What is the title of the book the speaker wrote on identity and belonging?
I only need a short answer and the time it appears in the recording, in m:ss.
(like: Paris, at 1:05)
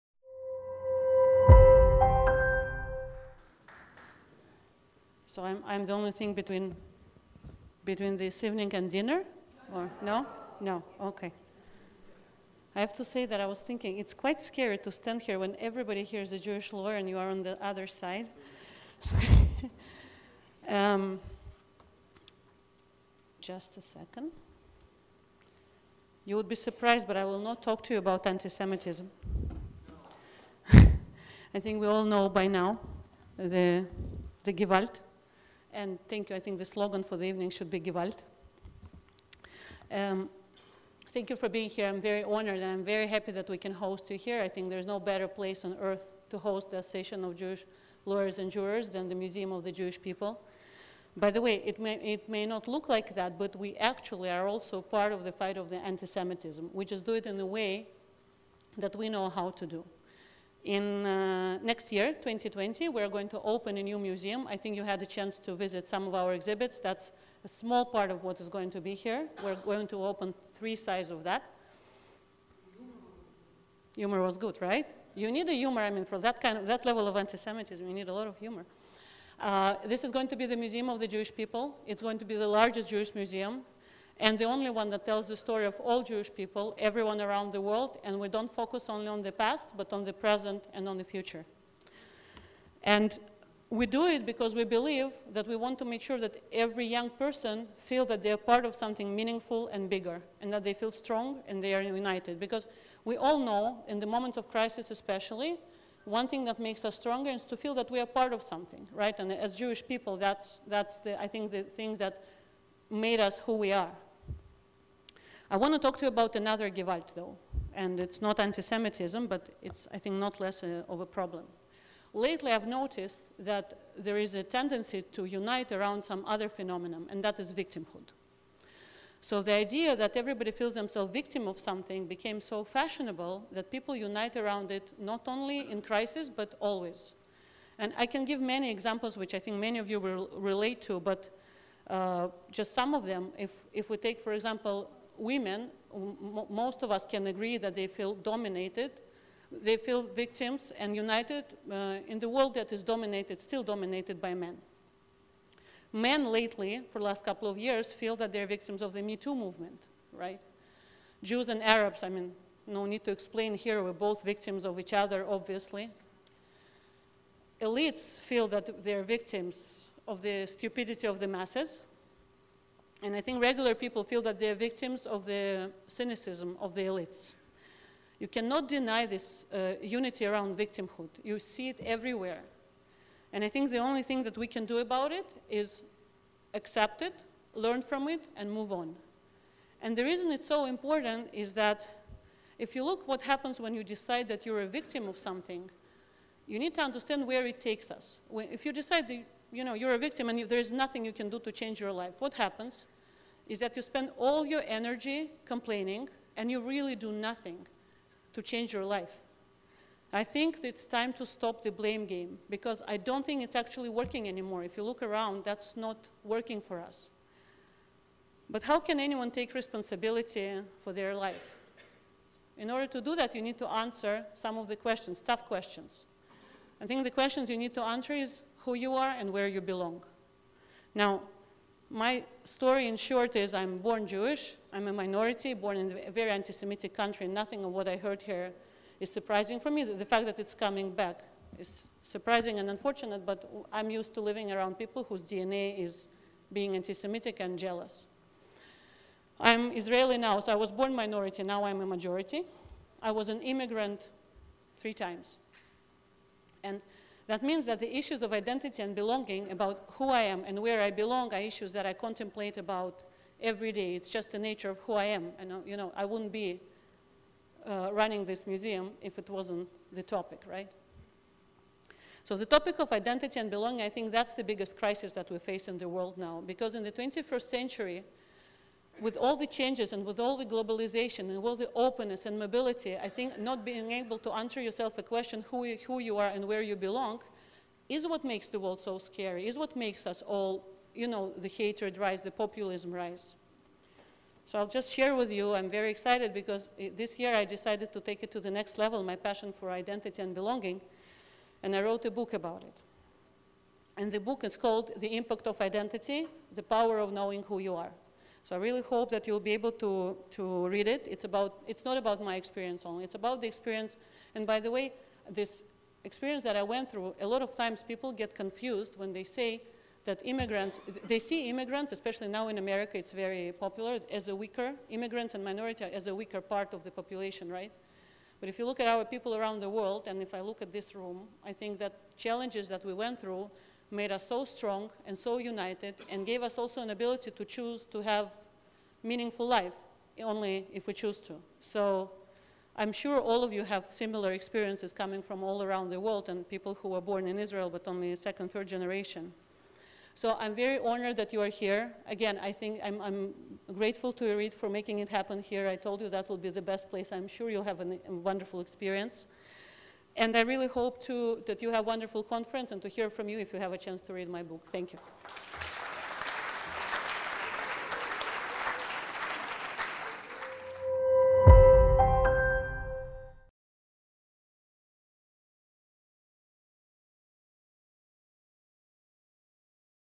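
The Impact of Identity, at 5:04.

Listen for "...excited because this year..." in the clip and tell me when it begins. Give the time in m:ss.
4:55.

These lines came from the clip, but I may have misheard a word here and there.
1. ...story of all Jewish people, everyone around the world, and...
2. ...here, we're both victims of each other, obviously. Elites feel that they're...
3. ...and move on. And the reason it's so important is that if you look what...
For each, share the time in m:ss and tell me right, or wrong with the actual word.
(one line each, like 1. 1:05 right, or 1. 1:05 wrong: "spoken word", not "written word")
1. 1:25 right
2. 2:43 right
3. 3:08 right.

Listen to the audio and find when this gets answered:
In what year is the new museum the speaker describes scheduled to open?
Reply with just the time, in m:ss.
1:02.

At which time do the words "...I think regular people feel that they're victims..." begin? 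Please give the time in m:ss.
2:53.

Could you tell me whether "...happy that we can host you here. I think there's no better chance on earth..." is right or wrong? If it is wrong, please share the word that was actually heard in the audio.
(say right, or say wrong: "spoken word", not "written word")
wrong: "place", not "chance".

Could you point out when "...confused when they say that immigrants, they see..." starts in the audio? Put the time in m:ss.
5:18.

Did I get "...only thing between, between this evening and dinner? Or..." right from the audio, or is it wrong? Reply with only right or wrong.
right.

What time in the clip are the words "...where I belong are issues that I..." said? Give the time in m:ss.
4:20.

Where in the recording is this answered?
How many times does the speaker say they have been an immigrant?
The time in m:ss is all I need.
4:14.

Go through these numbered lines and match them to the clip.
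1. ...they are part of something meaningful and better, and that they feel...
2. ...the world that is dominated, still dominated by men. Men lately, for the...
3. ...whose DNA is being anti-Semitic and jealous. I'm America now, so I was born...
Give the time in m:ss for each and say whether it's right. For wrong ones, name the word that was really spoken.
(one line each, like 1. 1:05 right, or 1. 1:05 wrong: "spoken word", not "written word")
1. 1:38 wrong: "bigger", not "better"
2. 2:32 right
3. 4:05 wrong: "Israeli", not "America".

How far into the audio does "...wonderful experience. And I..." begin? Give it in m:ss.
5:58.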